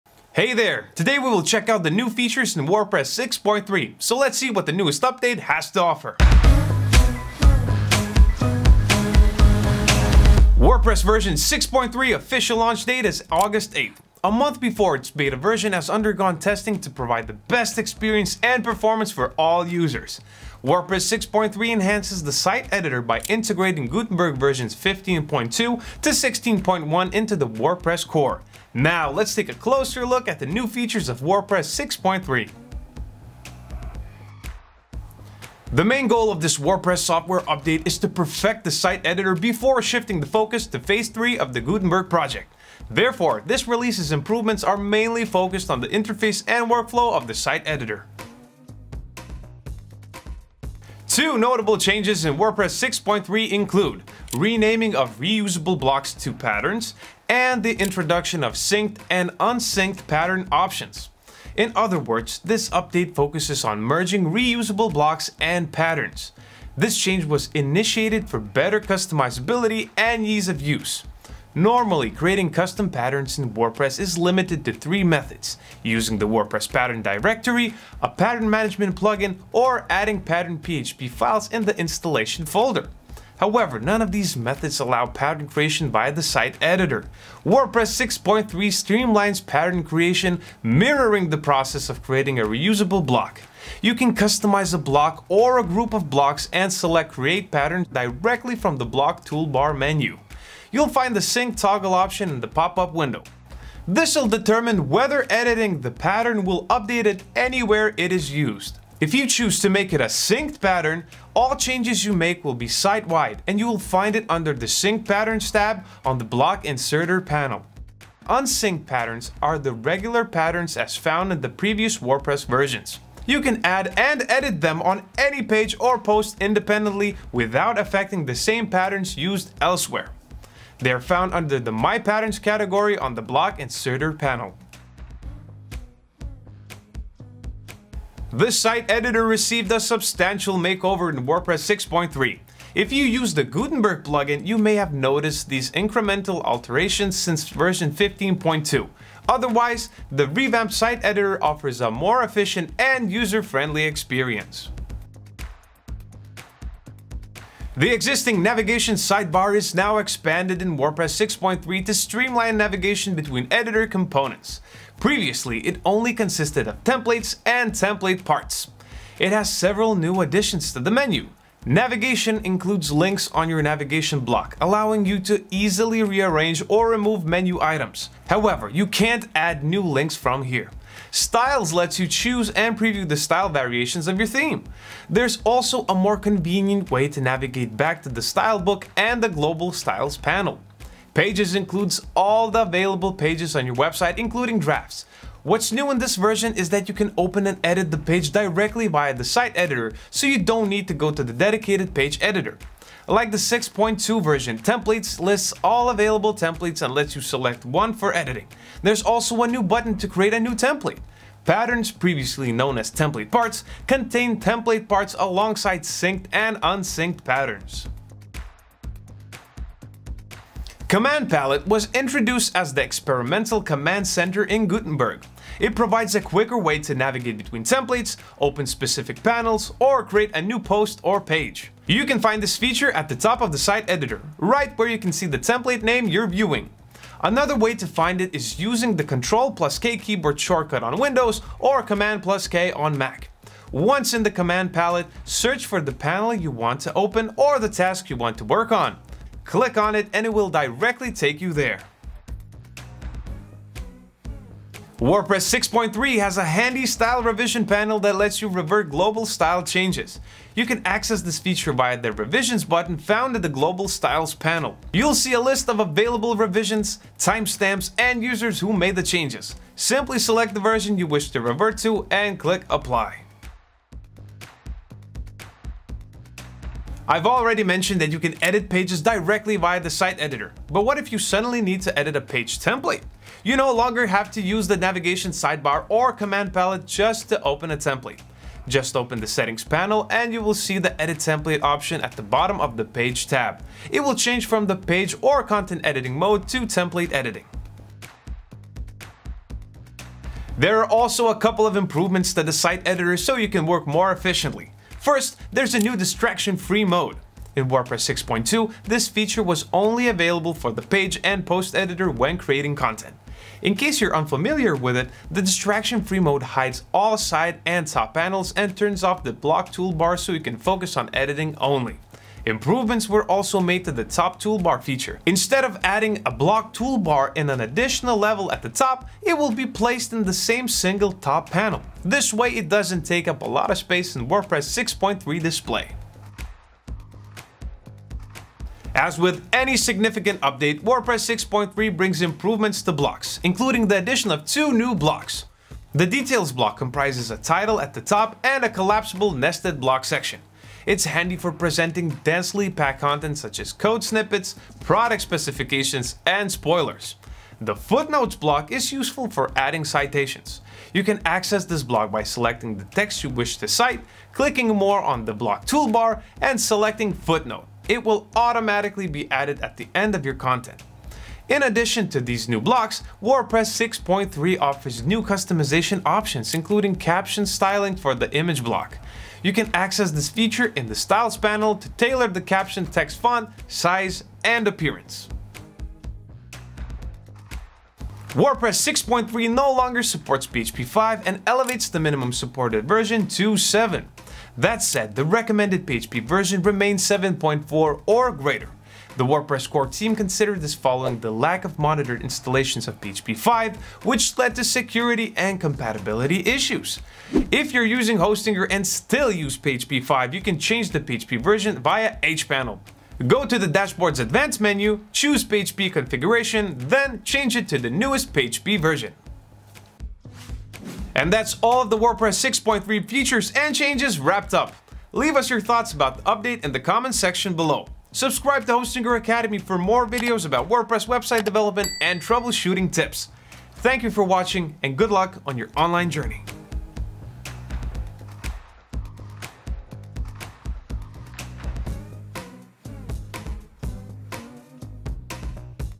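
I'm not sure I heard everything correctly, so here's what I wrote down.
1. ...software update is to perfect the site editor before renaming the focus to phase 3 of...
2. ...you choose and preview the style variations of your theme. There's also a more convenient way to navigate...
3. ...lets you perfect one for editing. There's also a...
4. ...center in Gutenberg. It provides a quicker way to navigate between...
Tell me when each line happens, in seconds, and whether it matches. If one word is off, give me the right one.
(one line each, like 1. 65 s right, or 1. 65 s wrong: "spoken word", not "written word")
1. 36 s wrong: "shifting", not "renaming"
2. 181 s right
3. 206 s wrong: "select", not "perfect"
4. 224 s right.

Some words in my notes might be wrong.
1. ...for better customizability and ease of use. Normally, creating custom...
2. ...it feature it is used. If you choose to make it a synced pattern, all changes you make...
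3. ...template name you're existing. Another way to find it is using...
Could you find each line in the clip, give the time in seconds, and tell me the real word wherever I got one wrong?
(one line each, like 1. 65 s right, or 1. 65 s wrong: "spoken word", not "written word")
1. 68 s right
2. 107 s wrong: "anywhere", not "feature"
3. 235 s wrong: "viewing", not "existing".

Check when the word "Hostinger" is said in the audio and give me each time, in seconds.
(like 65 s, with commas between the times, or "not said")
408 s, 428 s.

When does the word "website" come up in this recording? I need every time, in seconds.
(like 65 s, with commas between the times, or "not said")
193 s, 431 s.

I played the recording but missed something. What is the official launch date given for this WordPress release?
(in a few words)
August 8th.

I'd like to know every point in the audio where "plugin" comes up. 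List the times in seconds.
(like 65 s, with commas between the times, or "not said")
78 s, 144 s.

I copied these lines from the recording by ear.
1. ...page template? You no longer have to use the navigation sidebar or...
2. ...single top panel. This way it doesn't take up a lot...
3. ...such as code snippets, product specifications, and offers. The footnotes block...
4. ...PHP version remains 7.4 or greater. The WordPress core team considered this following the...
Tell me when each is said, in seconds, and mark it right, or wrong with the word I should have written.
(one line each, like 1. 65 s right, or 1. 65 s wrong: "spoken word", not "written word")
1. 282 s right
2. 330 s right
3. 353 s wrong: "spoilers", not "offers"
4. 395 s right.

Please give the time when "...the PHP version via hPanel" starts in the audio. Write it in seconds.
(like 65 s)
410 s.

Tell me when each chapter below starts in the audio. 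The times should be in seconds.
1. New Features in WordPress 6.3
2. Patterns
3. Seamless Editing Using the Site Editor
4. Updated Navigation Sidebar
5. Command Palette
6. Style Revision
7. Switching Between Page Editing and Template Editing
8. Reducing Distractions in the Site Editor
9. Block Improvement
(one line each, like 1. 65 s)
1. 33 s
2. 50 s
3. 137 s
4. 156 s
5. 220 s
6. 254 s
7. 276 s
8. 299 s
9. 338 s.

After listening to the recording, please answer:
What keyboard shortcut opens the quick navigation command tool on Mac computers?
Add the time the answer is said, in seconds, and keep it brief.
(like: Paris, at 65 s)
Command plus K, at 241 s.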